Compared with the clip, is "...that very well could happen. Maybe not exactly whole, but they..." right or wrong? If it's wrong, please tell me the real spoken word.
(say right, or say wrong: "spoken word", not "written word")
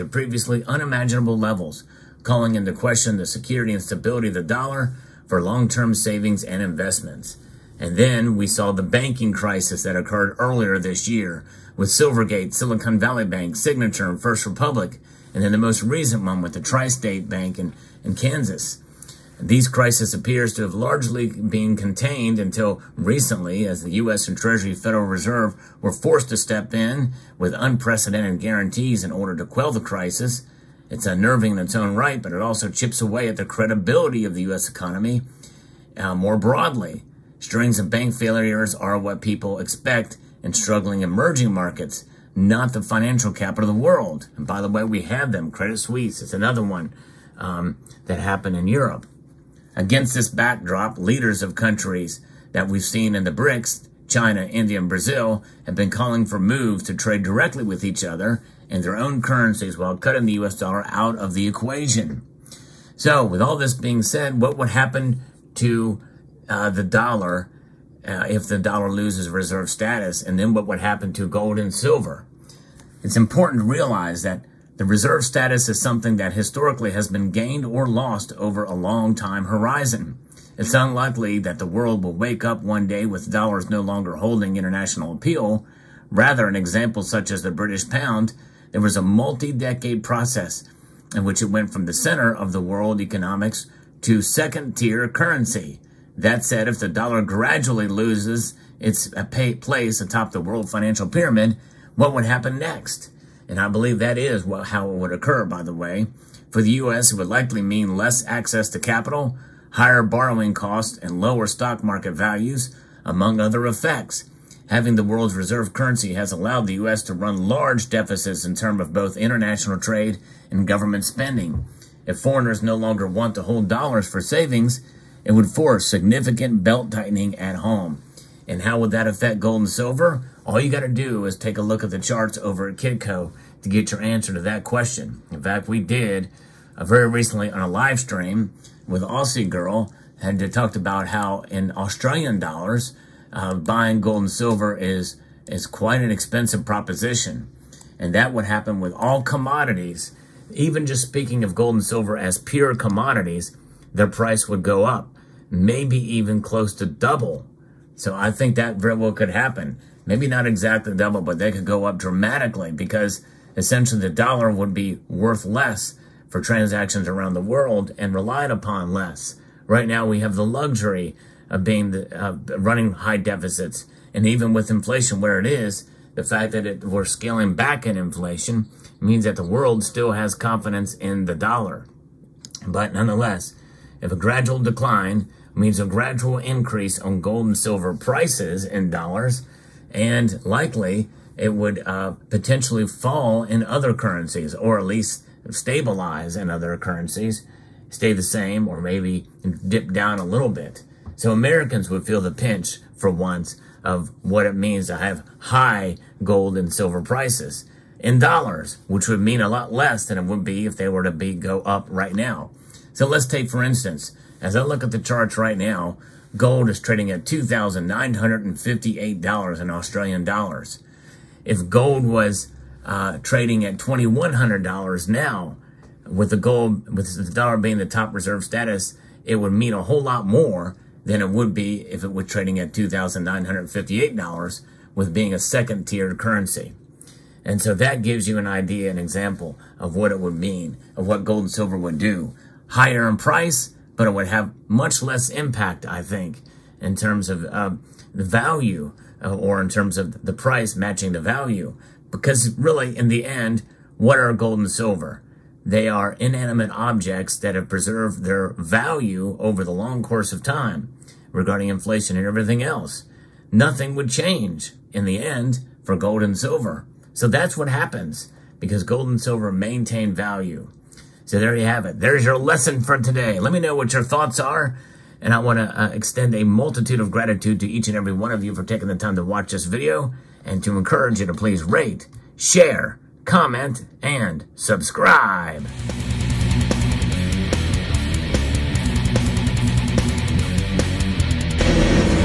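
wrong: "double", not "whole".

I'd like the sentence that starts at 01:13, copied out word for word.
It's important to realize that the reserve status is something that historically has been gained or lost over a long time horizon.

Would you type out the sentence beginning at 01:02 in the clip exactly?
So, with all this being said, what would happen to uh, the dollar uh, if the dollar loses reserve status?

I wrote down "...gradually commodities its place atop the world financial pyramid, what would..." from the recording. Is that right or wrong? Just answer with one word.
wrong.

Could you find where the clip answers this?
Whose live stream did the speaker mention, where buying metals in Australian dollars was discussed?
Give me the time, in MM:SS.
02:19.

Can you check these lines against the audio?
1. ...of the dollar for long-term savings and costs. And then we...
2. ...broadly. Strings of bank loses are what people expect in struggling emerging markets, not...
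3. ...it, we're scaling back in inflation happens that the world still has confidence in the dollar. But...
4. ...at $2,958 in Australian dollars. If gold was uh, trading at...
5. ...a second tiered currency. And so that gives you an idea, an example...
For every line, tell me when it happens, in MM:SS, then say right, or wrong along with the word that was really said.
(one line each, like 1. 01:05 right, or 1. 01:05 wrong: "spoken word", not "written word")
1. 00:04 wrong: "investments", not "costs"
2. 00:36 wrong: "failures", not "loses"
3. 02:56 wrong: "means", not "happens"
4. 03:37 right
5. 03:55 right.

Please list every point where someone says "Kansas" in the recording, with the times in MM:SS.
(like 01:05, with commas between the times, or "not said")
00:18.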